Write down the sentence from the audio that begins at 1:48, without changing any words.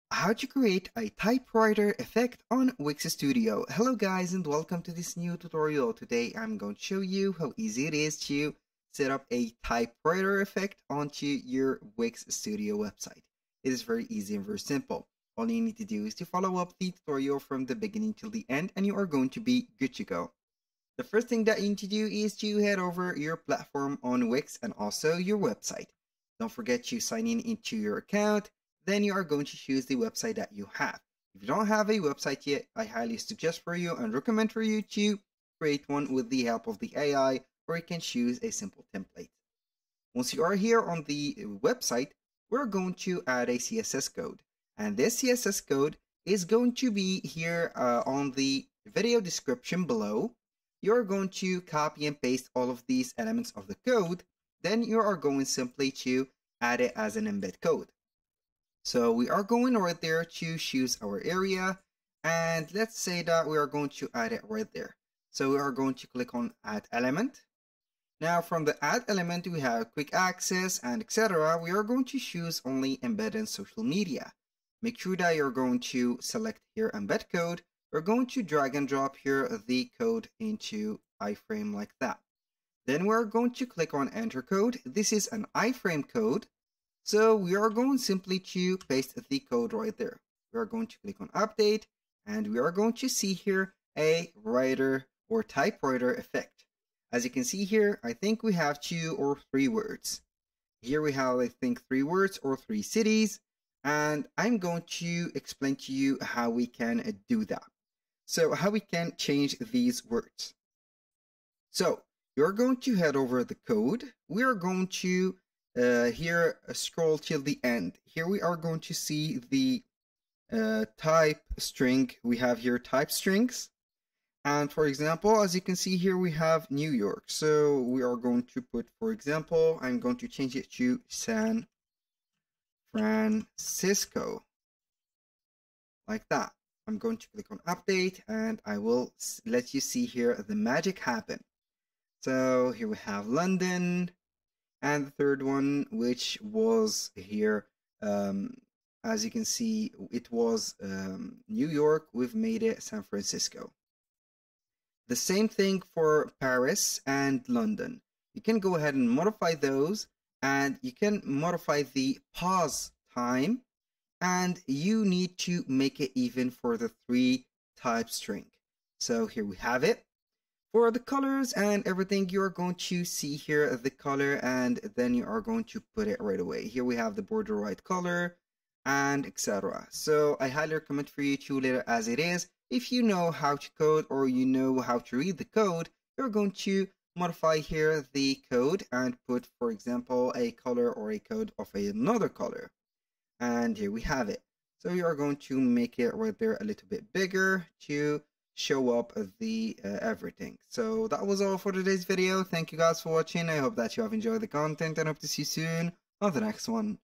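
So how we can change these words.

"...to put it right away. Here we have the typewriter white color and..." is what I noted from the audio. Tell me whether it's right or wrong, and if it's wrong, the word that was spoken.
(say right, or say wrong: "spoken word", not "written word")
wrong: "border", not "typewriter".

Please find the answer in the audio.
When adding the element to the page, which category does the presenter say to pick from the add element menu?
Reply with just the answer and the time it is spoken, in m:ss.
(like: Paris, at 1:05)
Embed in social media, at 1:12.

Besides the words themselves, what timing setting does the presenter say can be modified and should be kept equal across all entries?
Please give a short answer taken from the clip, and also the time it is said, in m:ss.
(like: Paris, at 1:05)
pause time, at 2:42.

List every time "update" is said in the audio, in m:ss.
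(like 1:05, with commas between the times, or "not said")
1:31, 2:17.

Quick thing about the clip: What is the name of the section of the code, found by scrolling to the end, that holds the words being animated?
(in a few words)
type strings.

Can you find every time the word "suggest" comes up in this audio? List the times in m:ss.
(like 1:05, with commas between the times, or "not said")
0:33.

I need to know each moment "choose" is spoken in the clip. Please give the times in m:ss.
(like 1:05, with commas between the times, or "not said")
0:29, 0:37, 1:00, 1:12.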